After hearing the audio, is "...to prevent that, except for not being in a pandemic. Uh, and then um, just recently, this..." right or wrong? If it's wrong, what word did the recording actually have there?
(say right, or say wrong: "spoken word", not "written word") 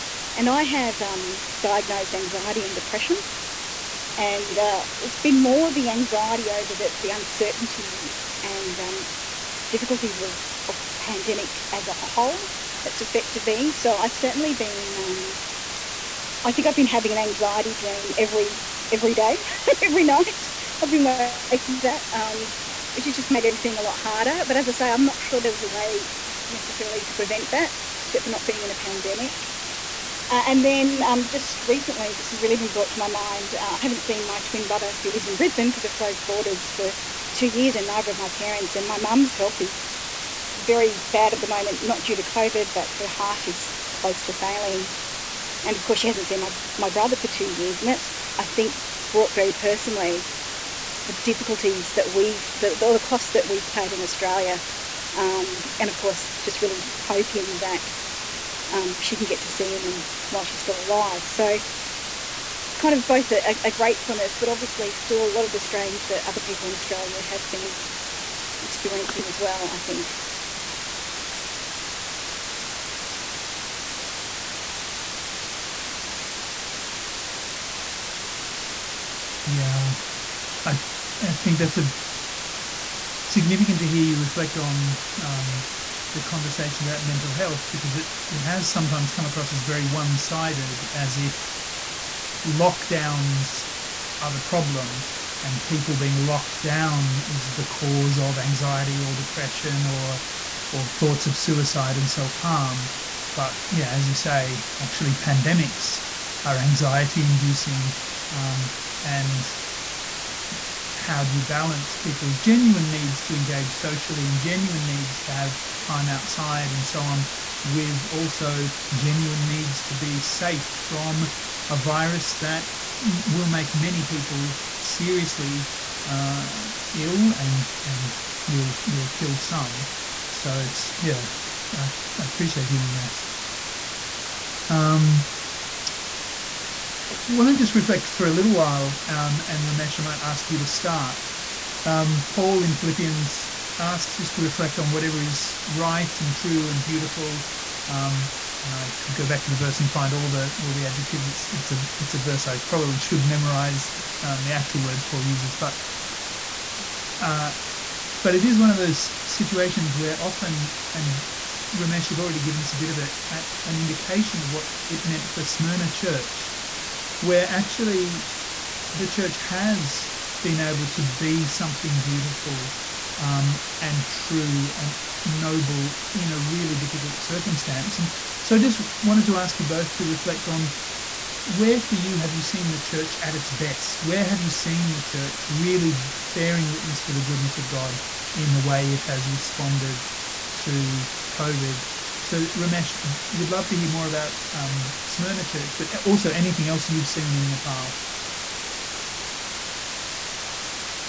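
right.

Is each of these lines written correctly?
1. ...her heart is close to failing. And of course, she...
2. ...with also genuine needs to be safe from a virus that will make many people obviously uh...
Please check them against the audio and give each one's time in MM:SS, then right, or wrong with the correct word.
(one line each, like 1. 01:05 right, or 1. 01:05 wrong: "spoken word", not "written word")
1. 00:42 right
2. 01:57 wrong: "seriously", not "obviously".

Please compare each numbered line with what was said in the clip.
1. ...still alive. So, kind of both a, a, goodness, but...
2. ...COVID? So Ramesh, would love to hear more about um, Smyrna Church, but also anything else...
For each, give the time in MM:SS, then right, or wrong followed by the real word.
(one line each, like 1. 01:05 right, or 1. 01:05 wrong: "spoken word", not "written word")
1. 01:00 wrong: "gratefulness", not "goodness"
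2. 03:11 right.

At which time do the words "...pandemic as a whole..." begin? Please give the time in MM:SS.
00:10.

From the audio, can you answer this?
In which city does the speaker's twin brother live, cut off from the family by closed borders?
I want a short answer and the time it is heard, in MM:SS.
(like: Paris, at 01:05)
Brisbane, at 00:35.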